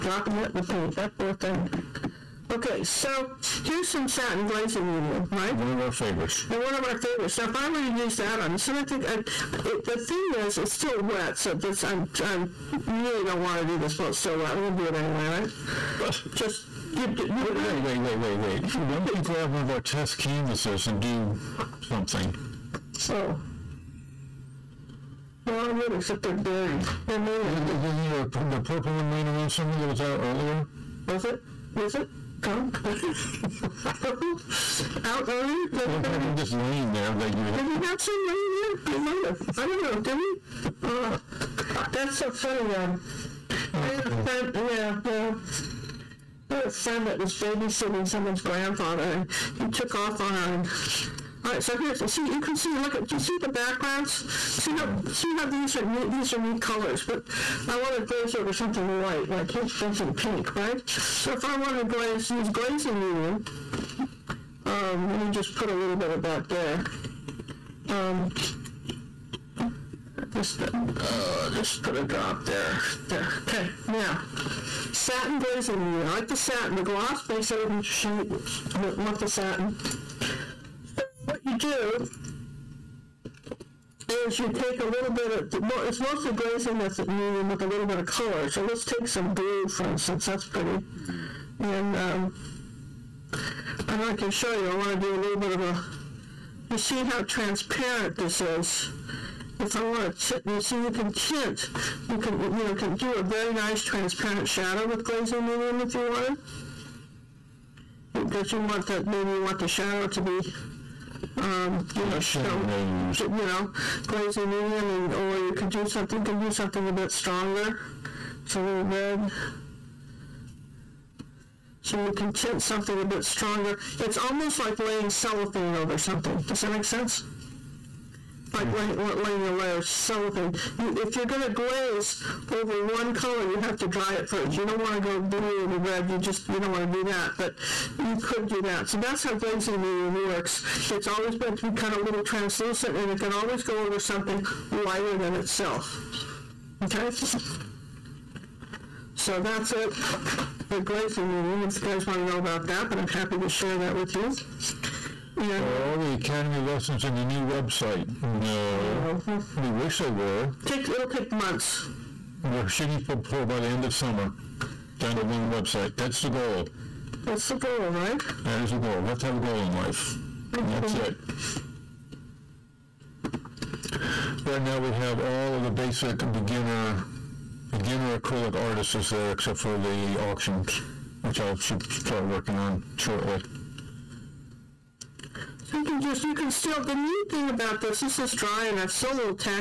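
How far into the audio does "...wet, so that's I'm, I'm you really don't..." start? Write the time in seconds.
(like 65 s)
11 s.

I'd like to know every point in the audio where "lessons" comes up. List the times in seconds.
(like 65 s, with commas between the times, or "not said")
156 s.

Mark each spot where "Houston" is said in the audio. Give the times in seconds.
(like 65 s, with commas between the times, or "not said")
not said.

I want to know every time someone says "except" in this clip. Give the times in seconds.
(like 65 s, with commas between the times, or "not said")
25 s, 179 s.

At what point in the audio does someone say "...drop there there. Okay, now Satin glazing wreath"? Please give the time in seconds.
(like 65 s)
72 s.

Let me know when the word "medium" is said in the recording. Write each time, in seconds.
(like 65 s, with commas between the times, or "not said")
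4 s, 62 s, 87 s, 105 s, 114 s, 139 s, 151 s.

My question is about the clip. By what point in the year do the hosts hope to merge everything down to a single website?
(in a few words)
End of summer.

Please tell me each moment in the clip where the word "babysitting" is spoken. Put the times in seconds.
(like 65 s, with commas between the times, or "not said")
47 s.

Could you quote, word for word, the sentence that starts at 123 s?
It's almost like laying cellophane over something.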